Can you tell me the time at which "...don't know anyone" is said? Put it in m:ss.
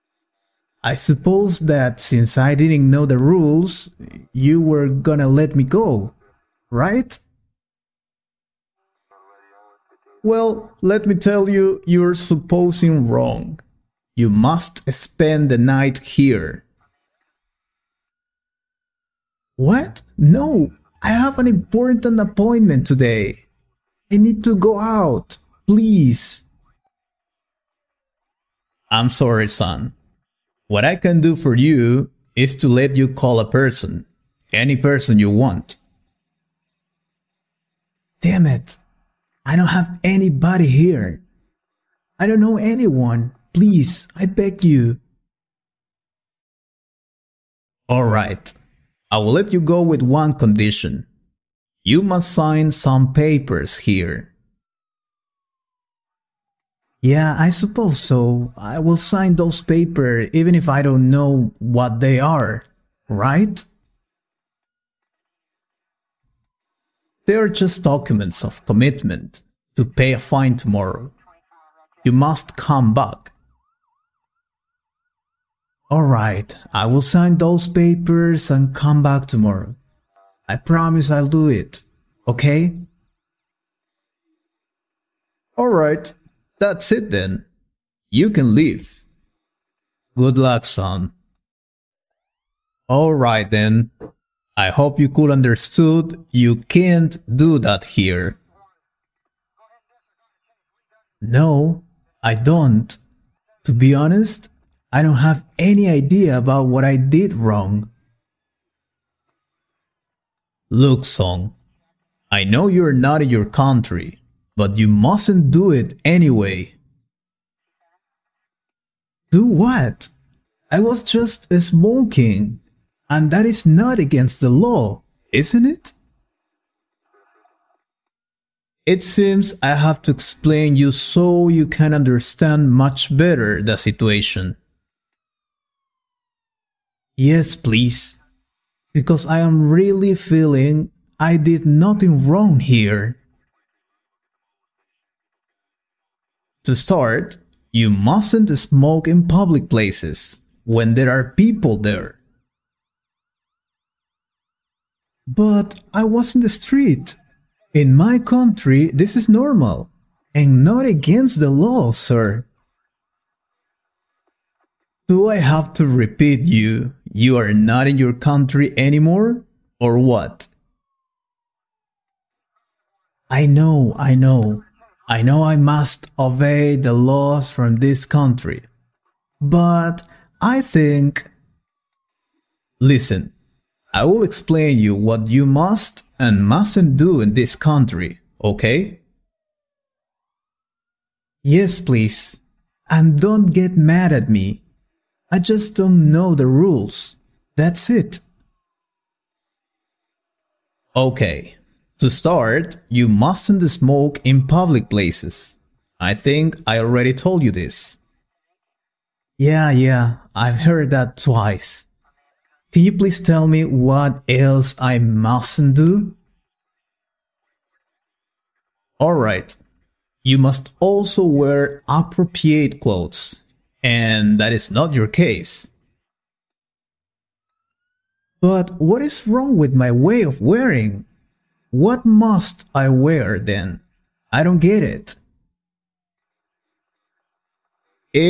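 0:42.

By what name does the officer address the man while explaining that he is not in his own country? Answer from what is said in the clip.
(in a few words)
Song.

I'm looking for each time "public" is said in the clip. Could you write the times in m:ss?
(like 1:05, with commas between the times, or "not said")
2:29, 3:24.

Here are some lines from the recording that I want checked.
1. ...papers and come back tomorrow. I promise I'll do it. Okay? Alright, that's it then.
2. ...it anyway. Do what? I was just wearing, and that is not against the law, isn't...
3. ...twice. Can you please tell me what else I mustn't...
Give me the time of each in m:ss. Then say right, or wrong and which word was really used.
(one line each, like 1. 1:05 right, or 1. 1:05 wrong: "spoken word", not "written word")
1. 1:17 right
2. 1:55 wrong: "smoking", not "wearing"
3. 3:31 right.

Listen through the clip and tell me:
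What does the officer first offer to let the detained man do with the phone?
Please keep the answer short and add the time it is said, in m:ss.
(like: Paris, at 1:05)
Call a person, at 0:33.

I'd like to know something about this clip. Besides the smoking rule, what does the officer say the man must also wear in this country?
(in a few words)
Appropriate clothes.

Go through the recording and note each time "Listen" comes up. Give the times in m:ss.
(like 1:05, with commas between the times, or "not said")
3:02.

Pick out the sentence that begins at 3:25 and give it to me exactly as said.
I think I already told you this.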